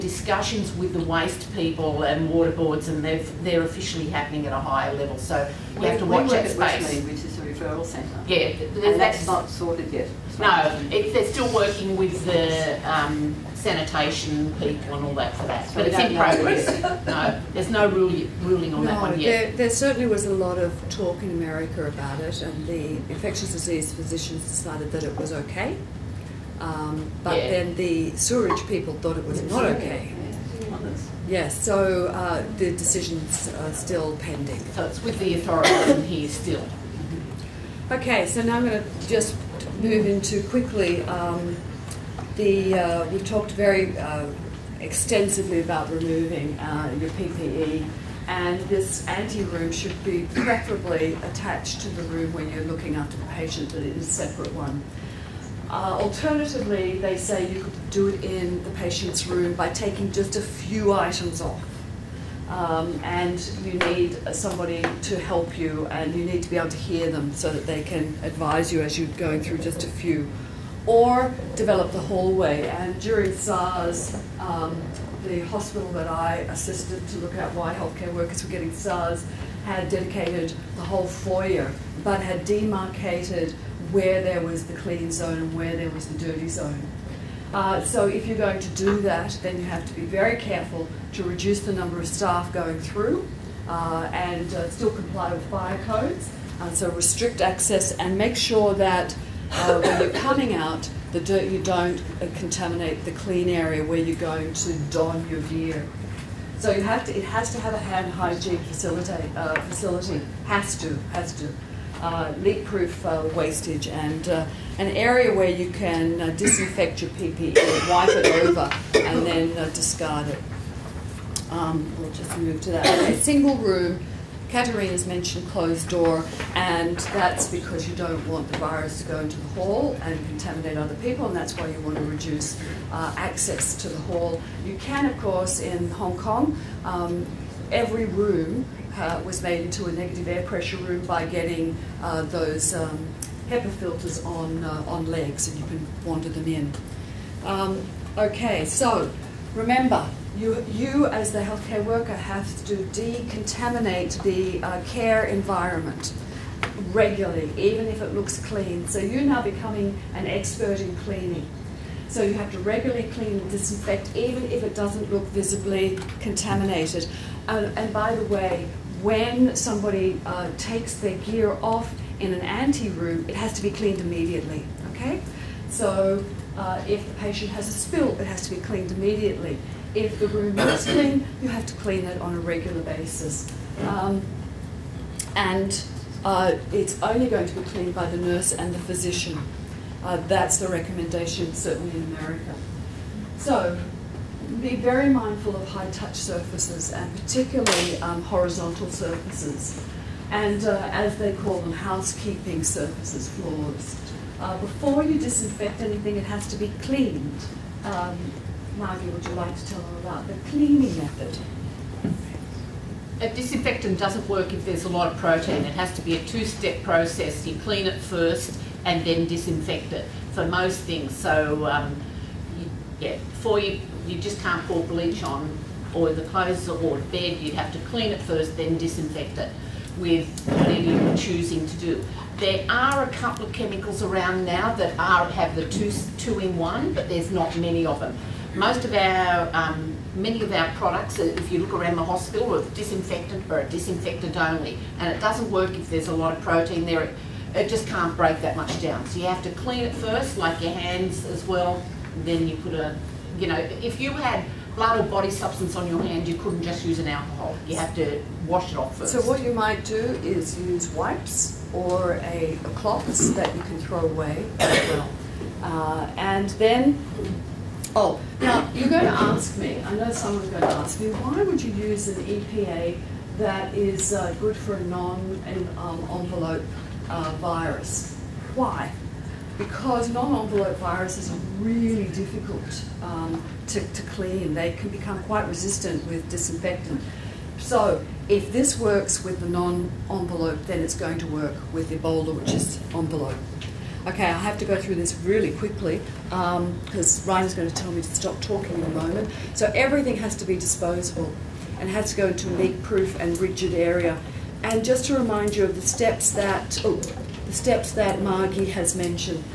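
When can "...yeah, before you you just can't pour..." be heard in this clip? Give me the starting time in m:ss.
3:42.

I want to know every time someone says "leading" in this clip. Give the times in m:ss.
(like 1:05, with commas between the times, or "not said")
not said.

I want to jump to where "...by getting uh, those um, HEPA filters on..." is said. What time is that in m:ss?
2:21.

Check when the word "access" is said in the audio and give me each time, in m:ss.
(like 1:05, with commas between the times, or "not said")
1:37, 2:13.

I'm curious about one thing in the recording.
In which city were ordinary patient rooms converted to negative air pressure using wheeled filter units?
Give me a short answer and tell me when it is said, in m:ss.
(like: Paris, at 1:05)
Hong Kong, at 2:15.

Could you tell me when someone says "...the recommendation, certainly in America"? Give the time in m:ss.
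3:10.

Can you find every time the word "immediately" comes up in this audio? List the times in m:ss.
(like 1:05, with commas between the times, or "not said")
2:53, 2:58.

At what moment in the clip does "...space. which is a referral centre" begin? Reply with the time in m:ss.
0:06.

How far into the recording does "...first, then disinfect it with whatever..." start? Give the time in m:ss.
3:48.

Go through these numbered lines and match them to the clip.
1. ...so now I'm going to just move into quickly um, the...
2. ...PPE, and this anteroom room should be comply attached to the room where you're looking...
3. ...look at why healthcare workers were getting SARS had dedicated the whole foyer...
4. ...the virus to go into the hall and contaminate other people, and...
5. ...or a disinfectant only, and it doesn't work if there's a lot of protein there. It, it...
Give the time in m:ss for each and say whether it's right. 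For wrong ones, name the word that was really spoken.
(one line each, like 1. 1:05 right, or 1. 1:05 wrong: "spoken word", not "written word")
1. 0:38 right
2. 0:47 wrong: "preferably", not "comply"
3. 1:17 right
4. 2:08 right
5. 4:03 right.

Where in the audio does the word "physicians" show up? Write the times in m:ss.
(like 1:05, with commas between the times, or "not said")
0:23, 3:08.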